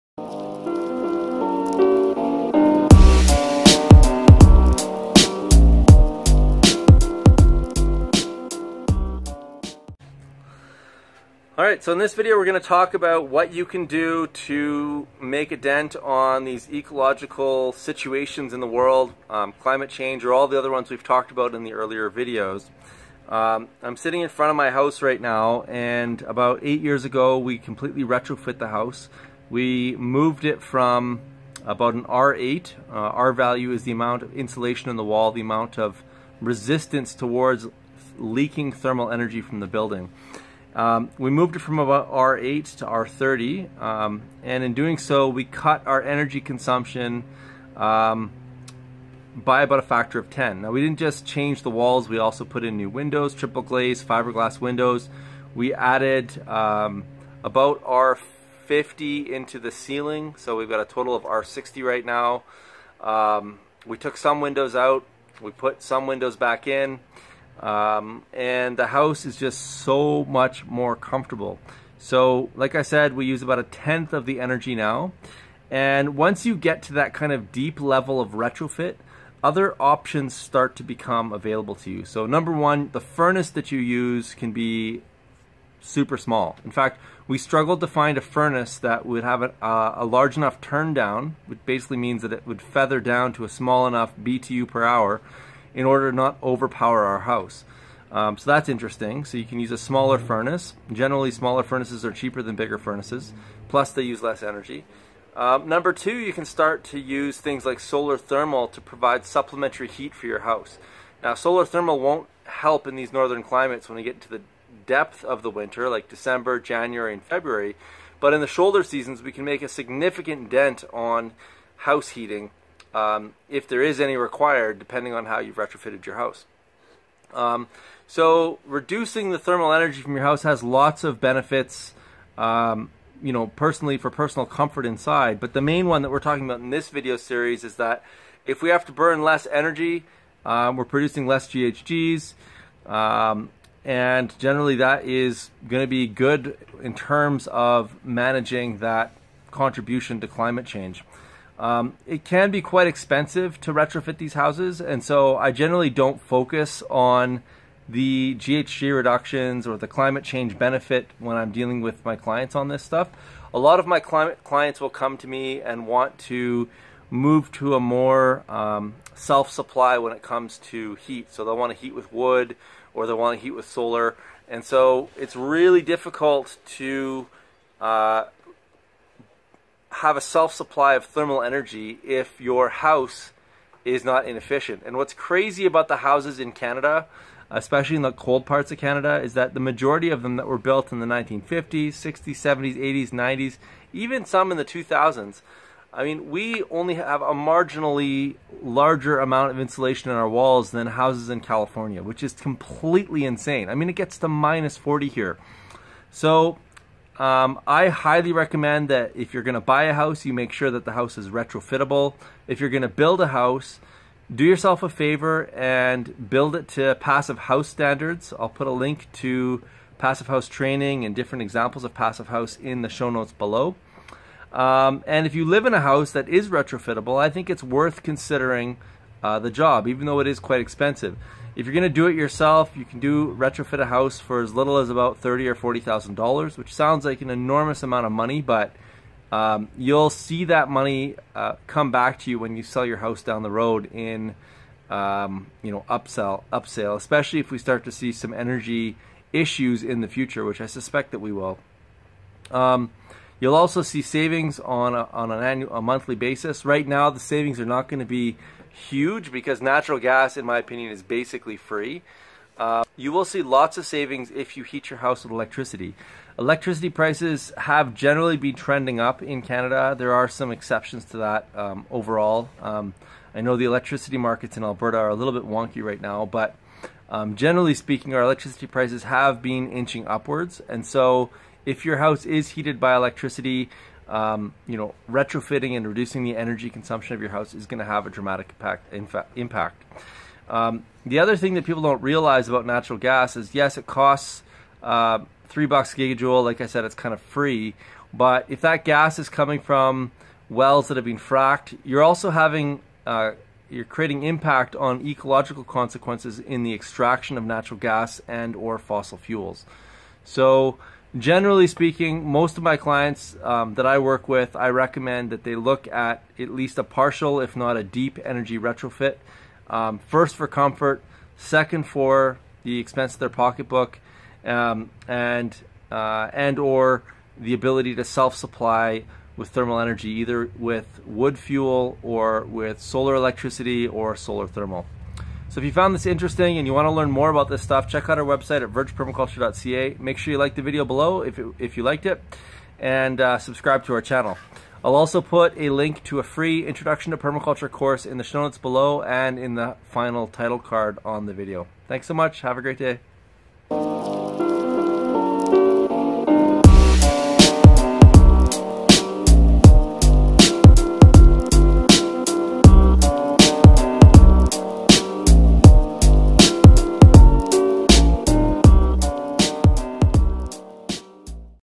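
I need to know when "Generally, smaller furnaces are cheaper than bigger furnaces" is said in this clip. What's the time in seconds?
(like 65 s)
100 s.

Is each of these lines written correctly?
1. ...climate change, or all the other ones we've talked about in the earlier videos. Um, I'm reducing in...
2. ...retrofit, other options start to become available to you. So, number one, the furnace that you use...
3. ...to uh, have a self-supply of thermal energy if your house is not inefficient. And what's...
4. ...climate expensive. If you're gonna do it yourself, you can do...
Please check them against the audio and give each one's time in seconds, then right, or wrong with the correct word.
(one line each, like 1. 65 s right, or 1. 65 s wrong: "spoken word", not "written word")
1. 19 s wrong: "sitting", not "reducing"
2. 78 s right
3. 176 s right
4. 230 s wrong: "quite", not "climate".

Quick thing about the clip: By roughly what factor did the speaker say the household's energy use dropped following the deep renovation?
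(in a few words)
10.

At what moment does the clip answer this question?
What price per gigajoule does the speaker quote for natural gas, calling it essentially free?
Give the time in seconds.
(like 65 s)
295 s.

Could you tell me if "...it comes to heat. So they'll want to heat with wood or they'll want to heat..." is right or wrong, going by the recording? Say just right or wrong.
right.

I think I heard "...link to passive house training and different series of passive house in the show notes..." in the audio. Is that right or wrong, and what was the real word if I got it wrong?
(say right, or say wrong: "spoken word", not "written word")
wrong: "examples", not "series".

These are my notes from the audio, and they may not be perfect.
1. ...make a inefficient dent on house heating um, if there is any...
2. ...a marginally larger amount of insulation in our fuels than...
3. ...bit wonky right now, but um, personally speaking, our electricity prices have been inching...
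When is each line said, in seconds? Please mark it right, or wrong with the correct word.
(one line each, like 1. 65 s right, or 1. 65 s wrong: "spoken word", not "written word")
1. 119 s wrong: "significant", not "inefficient"
2. 197 s wrong: "walls", not "fuels"
3. 275 s wrong: "generally", not "personally".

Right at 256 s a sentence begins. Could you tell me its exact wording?
Right now, the savings are not going to be huge because natural gas, in my opinion, is basically free.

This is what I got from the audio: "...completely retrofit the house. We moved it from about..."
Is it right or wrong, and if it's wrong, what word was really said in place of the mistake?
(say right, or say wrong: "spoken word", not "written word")
right.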